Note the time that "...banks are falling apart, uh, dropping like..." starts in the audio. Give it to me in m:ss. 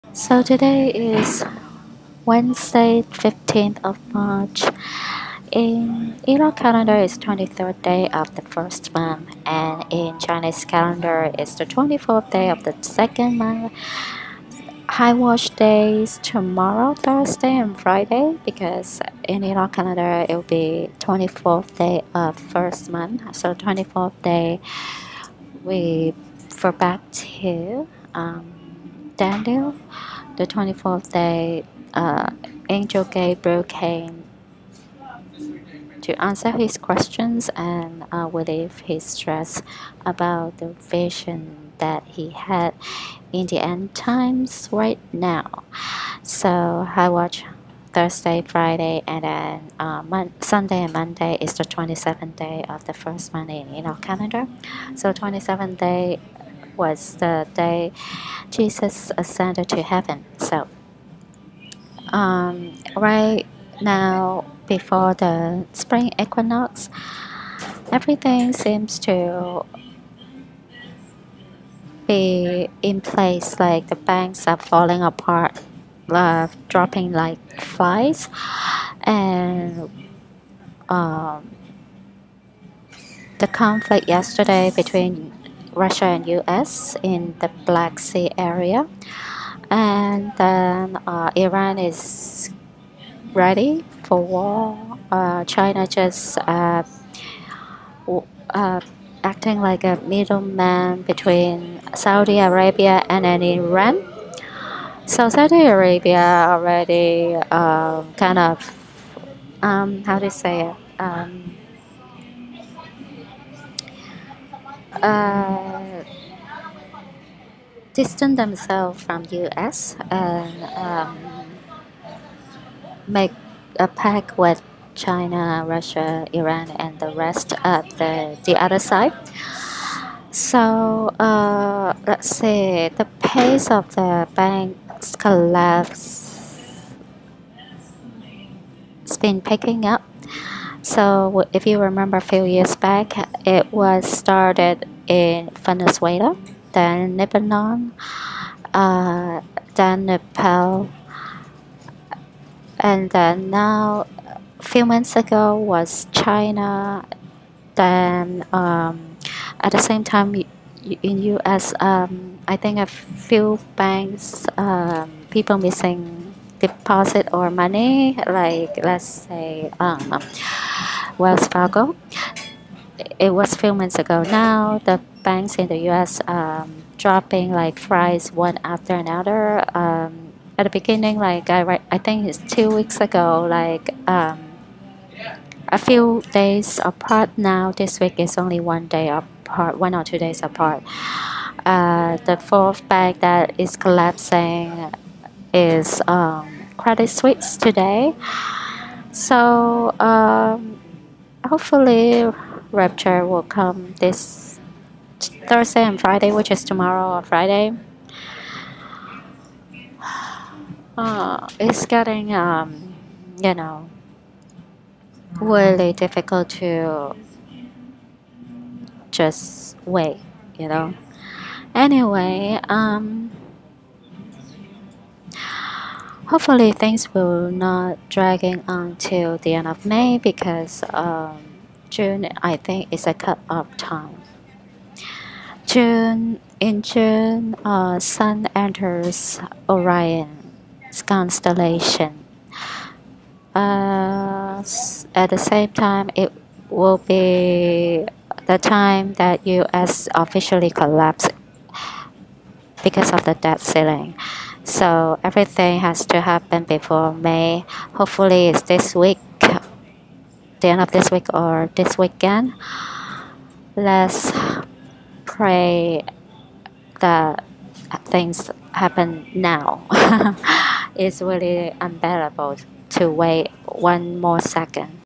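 1:13.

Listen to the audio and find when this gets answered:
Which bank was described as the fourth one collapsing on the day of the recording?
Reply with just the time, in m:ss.
3:16.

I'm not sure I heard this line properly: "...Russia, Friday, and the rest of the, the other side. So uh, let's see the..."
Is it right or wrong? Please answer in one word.
wrong.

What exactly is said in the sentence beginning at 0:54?
So 27th day was the day Jesus ascended to heaven.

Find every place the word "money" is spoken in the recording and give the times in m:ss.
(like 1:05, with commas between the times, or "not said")
2:47.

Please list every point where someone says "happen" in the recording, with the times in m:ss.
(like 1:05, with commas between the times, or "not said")
4:16, 4:28.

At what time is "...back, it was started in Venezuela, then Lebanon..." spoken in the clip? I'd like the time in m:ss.
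2:22.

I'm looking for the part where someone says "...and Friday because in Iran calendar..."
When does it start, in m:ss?
0:17.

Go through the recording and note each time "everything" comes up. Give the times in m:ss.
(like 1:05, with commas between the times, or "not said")
1:07, 4:15.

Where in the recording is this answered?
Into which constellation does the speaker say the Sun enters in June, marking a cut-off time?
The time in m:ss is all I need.
3:59.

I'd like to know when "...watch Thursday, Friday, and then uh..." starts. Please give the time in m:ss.
0:47.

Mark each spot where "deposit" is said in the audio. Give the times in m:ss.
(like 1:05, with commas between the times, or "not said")
2:46.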